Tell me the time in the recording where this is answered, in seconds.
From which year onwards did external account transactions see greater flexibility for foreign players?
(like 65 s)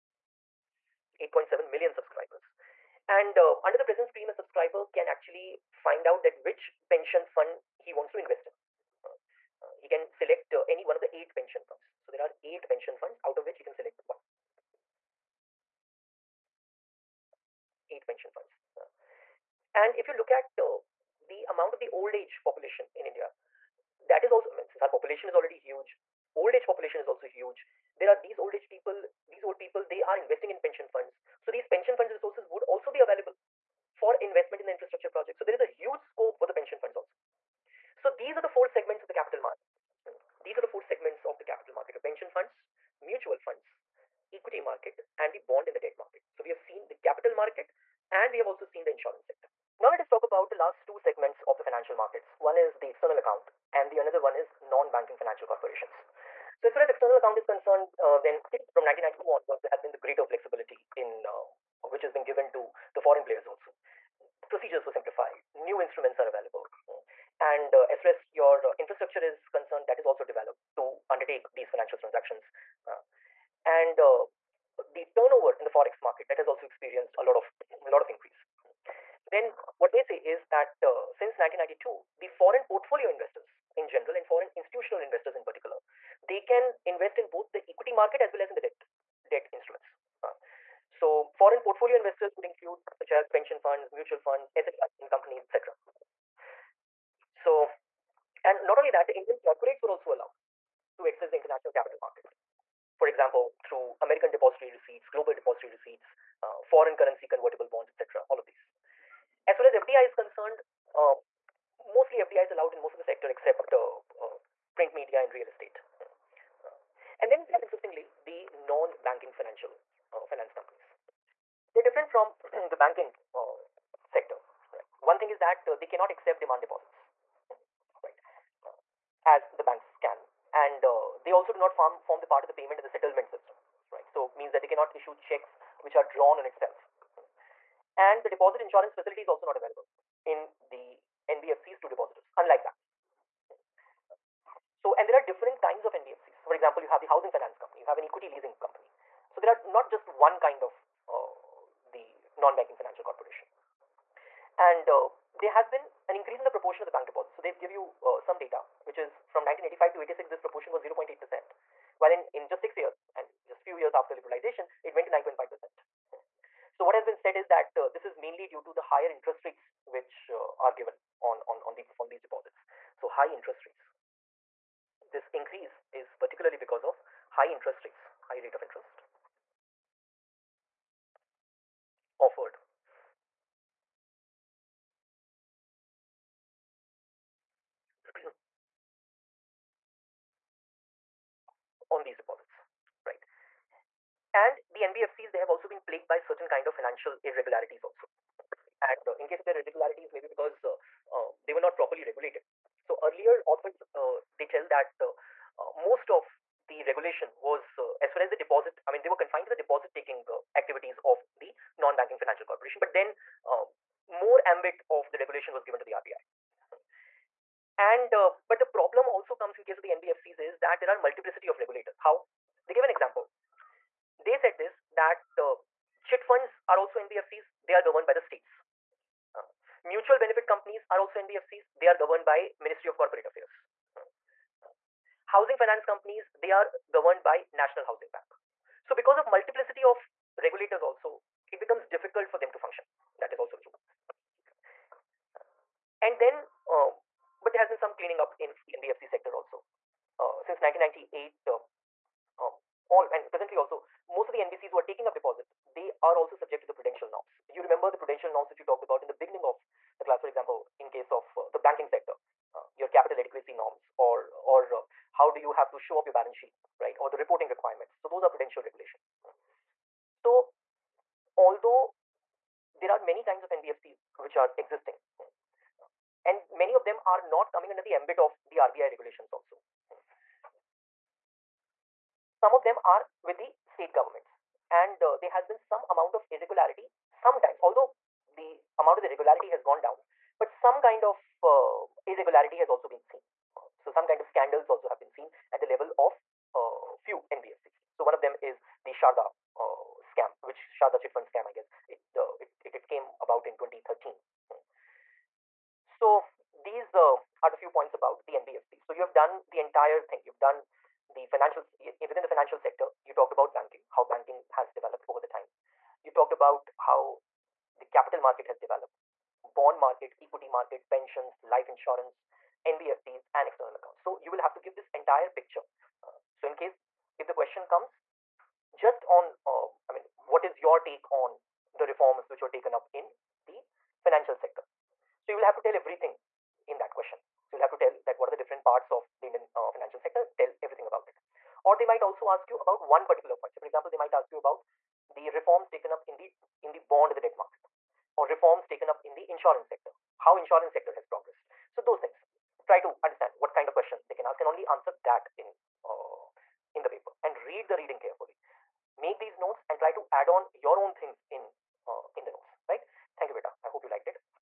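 58 s.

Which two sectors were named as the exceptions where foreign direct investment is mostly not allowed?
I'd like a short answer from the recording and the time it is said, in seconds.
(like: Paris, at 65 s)
Print media and real estate, at 114 s.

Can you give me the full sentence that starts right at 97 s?
So, and not only that, the Indian corporates were also allowed to access the international capital market.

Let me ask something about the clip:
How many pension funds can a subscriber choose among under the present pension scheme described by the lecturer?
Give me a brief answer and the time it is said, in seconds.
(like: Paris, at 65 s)
8, at 12 s.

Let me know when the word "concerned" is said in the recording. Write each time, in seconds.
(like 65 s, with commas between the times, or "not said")
57 s, 69 s, 110 s.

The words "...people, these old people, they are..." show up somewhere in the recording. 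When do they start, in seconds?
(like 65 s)
28 s.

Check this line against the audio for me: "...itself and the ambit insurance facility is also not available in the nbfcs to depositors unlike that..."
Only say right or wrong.
wrong.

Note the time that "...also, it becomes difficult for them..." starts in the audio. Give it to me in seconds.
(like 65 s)
240 s.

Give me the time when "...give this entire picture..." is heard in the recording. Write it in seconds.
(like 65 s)
324 s.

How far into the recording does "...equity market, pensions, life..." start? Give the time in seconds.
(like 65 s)
320 s.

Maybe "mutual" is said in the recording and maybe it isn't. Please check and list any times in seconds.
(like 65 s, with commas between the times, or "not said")
43 s, 93 s, 229 s.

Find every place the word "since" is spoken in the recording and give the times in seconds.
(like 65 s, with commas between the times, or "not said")
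24 s, 81 s, 250 s.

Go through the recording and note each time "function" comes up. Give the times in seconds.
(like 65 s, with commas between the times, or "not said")
242 s.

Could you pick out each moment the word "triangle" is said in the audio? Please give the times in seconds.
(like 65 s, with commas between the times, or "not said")
not said.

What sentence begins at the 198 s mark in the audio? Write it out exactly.
And uh, in case of their irregularities, maybe because uh, uh, they were not properly regulated.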